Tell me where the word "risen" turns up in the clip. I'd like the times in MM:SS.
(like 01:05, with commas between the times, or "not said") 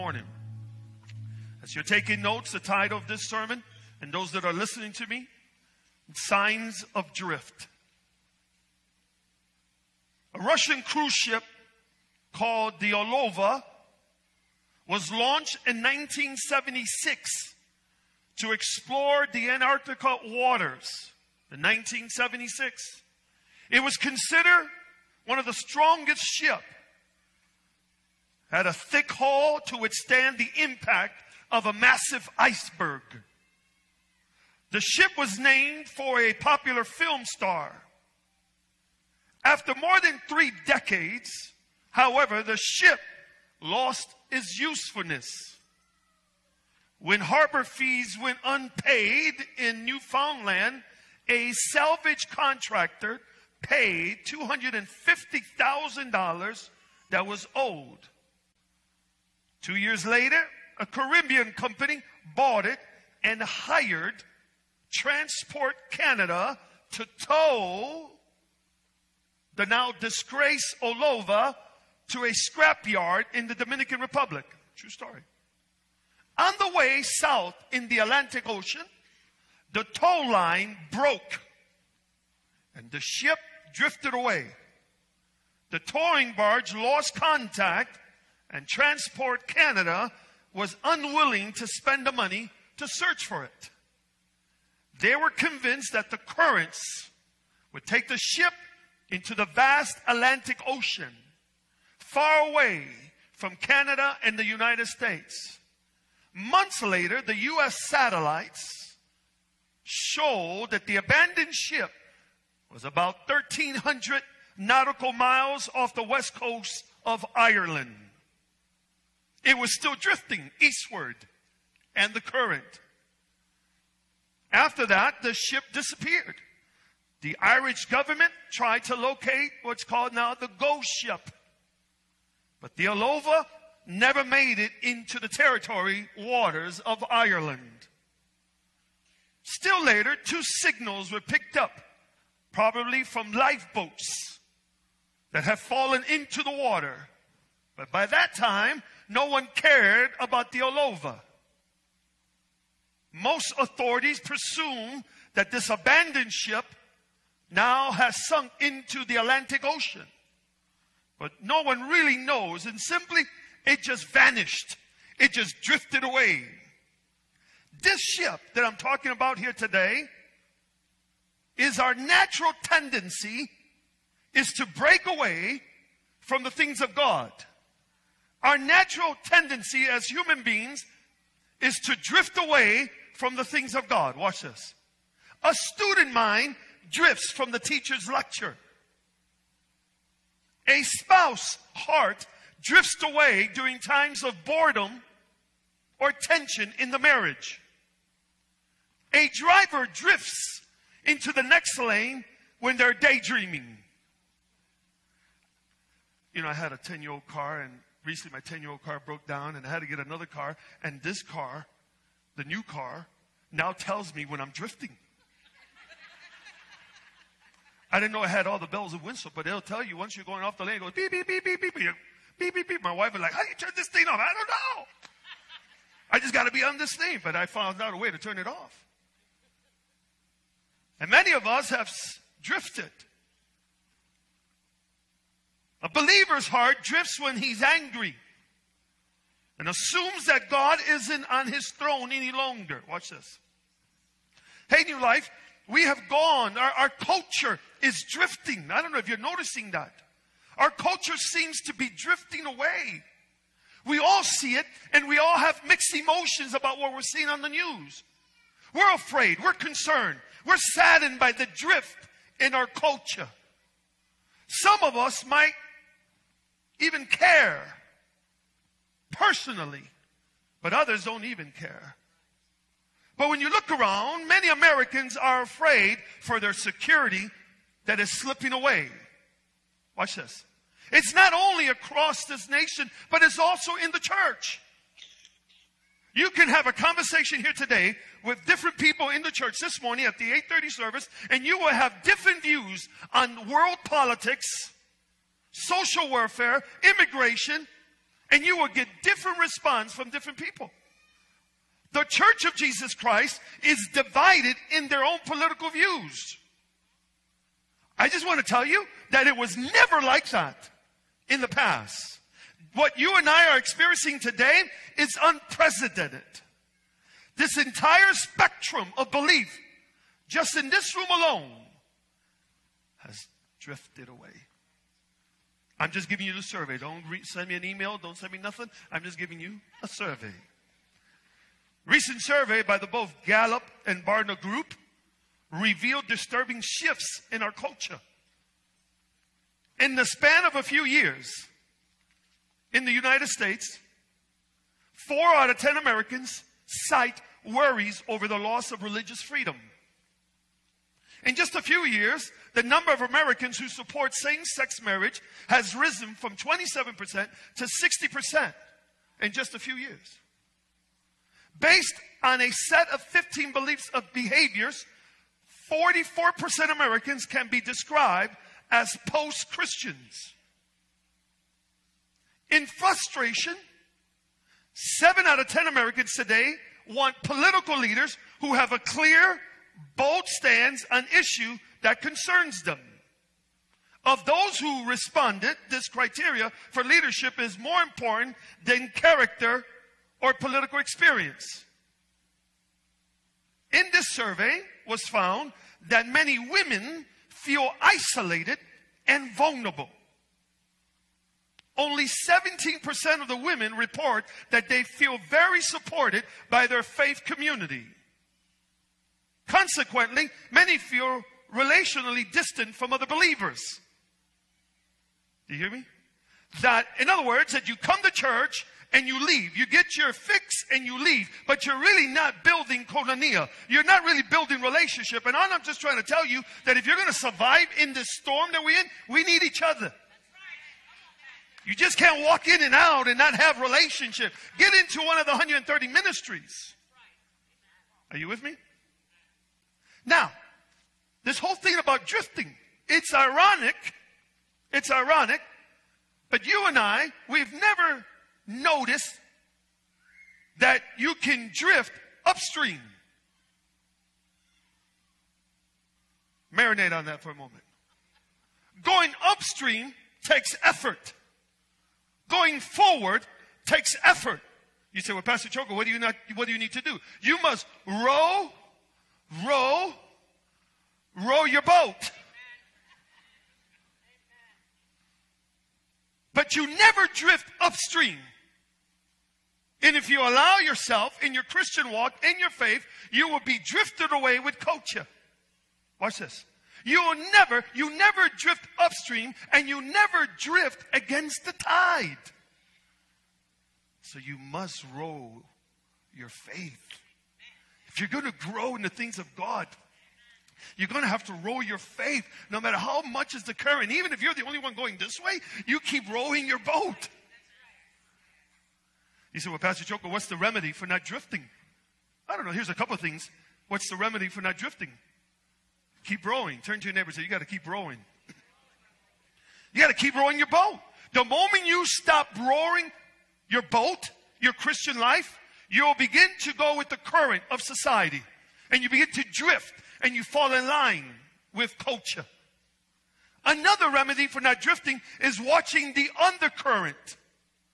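05:55.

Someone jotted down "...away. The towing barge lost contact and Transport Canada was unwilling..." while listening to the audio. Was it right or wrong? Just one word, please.
right.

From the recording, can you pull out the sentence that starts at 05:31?
Recent survey by the both Gallup and Barna Group revealed disturbing shifts in our culture.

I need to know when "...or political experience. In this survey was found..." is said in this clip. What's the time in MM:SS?
06:30.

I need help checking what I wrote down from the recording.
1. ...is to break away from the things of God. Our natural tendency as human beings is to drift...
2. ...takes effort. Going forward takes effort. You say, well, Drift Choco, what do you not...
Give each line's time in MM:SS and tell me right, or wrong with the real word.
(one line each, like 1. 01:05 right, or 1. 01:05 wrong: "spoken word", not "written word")
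1. 02:54 right
2. 07:40 wrong: "Pastor", not "Drift".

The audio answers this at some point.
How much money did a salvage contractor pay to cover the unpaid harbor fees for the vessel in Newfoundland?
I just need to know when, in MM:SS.
00:54.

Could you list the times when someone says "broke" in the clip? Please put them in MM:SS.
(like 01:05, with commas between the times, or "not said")
01:20, 03:29.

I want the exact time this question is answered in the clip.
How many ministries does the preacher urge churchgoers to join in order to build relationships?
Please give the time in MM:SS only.
07:15.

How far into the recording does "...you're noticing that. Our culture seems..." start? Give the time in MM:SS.
04:09.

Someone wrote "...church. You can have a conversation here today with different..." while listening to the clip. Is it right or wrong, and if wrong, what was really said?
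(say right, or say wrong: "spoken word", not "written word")
right.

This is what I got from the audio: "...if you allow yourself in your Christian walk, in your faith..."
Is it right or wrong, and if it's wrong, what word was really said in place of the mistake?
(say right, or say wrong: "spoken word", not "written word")
right.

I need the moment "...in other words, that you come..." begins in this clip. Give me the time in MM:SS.
06:56.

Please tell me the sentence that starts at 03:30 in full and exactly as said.
And this car, the new car, now tells me when I'm drifting.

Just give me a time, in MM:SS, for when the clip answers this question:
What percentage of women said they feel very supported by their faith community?
06:42.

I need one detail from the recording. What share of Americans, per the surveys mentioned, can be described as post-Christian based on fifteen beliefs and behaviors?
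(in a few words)
44%.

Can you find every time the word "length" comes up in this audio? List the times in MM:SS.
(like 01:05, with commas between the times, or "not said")
not said.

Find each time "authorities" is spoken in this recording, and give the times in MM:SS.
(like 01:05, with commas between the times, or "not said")
02:33.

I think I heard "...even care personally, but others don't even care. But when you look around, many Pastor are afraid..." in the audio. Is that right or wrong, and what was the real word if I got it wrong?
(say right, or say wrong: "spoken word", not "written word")
wrong: "Americans", not "Pastor".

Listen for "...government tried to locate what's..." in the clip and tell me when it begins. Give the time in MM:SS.
02:07.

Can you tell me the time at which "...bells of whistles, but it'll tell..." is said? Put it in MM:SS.
03:38.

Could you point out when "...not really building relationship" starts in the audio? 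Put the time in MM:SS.
07:03.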